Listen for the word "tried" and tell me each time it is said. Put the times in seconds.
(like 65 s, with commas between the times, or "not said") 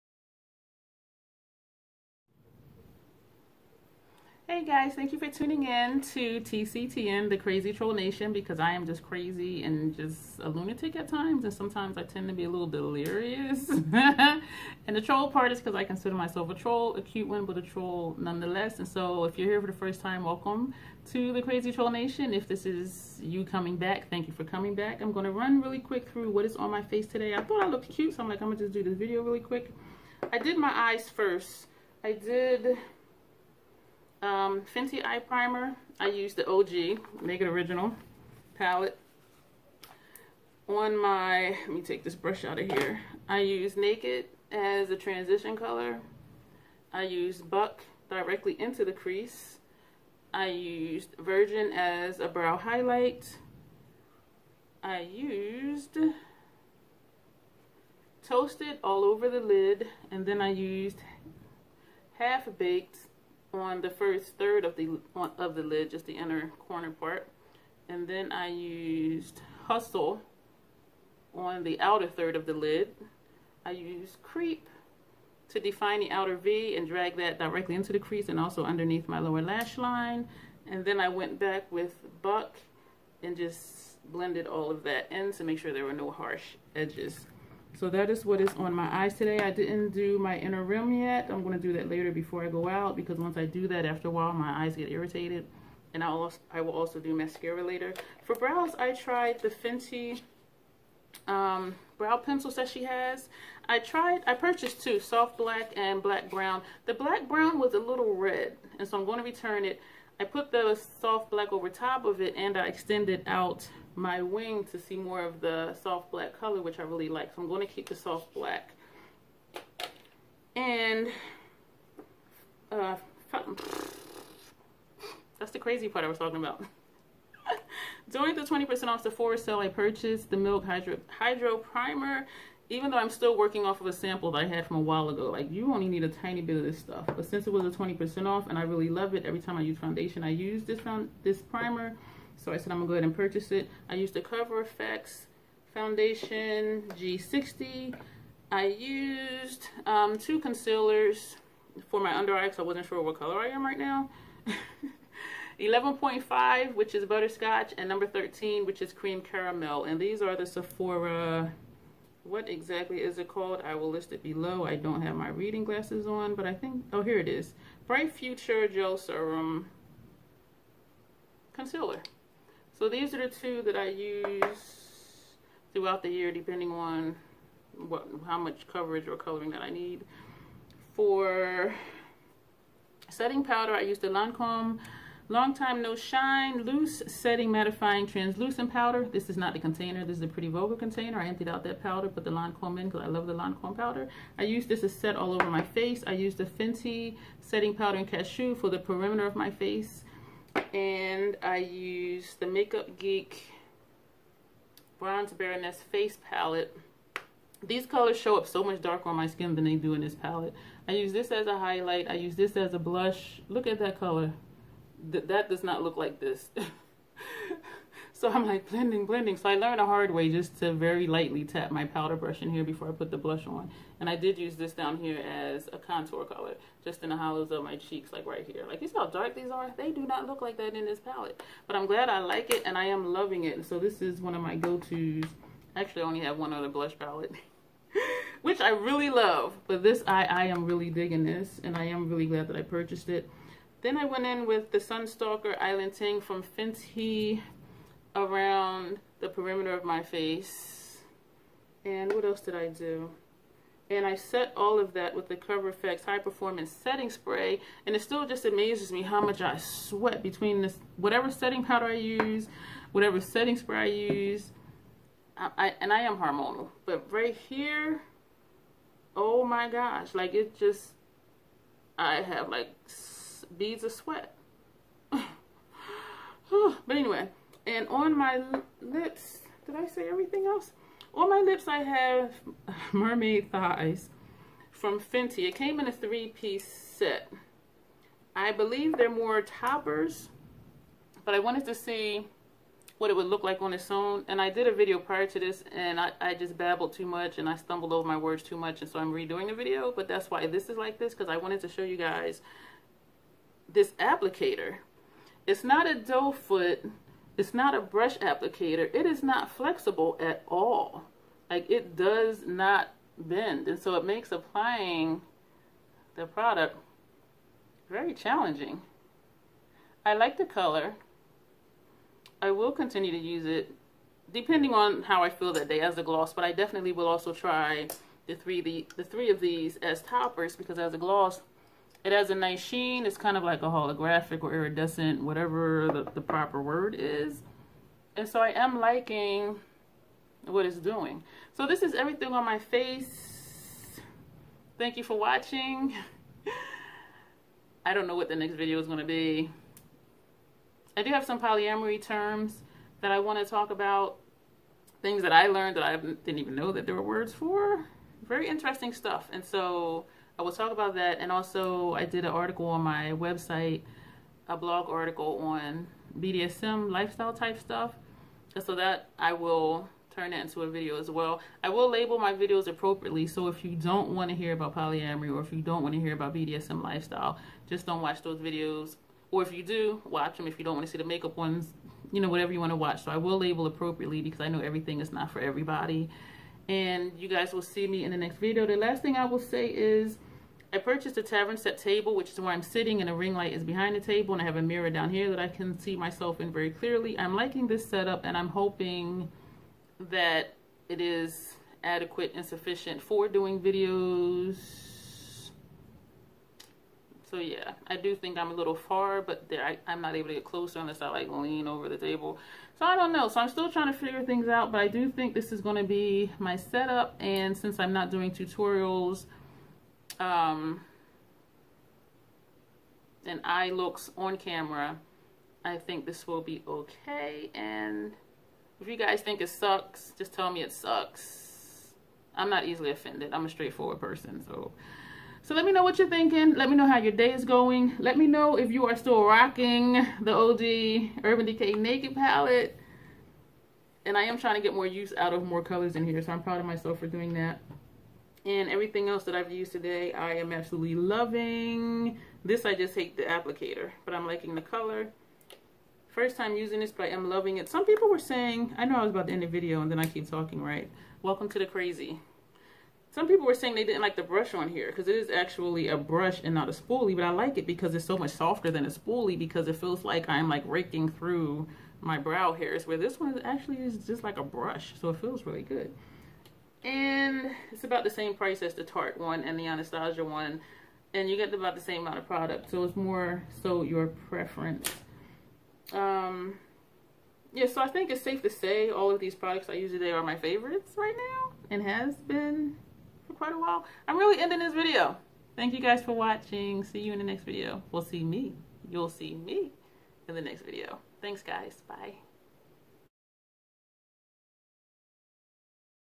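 98 s, 103 s.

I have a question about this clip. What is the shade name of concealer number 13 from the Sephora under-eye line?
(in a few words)
Cream Caramel.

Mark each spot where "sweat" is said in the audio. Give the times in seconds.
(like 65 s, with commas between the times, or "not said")
259 s, 273 s.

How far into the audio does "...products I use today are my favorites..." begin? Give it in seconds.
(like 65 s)
489 s.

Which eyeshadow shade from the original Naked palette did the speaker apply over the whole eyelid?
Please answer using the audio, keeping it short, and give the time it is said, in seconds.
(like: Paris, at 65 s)
Toasted, at 58 s.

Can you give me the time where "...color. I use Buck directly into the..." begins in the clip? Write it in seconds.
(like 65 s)
45 s.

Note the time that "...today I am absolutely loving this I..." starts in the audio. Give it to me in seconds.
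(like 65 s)
449 s.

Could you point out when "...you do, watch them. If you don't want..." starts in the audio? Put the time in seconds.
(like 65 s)
379 s.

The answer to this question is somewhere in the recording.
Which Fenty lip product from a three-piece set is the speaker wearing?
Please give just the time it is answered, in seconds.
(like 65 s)
282 s.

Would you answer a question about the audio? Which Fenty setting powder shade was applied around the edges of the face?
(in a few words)
Cashew.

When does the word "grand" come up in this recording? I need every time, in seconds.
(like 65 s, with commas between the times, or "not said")
not said.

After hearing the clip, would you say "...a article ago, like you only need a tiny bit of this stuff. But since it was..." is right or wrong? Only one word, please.
wrong.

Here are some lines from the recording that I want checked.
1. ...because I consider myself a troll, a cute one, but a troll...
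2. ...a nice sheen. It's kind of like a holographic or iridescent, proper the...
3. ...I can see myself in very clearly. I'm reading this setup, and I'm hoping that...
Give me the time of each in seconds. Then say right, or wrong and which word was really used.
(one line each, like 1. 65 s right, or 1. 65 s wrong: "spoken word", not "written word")
1. 15 s right
2. 332 s wrong: "whatever", not "proper"
3. 395 s wrong: "liking", not "reading".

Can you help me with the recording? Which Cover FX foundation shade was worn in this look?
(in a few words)
G60.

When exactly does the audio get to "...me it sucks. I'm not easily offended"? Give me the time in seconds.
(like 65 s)
430 s.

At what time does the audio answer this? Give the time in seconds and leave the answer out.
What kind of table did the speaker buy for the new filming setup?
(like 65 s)
391 s.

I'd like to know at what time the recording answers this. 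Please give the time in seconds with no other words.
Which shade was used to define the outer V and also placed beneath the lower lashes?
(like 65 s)
74 s.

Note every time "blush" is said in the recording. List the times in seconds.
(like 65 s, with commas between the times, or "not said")
212 s, 223 s, 236 s.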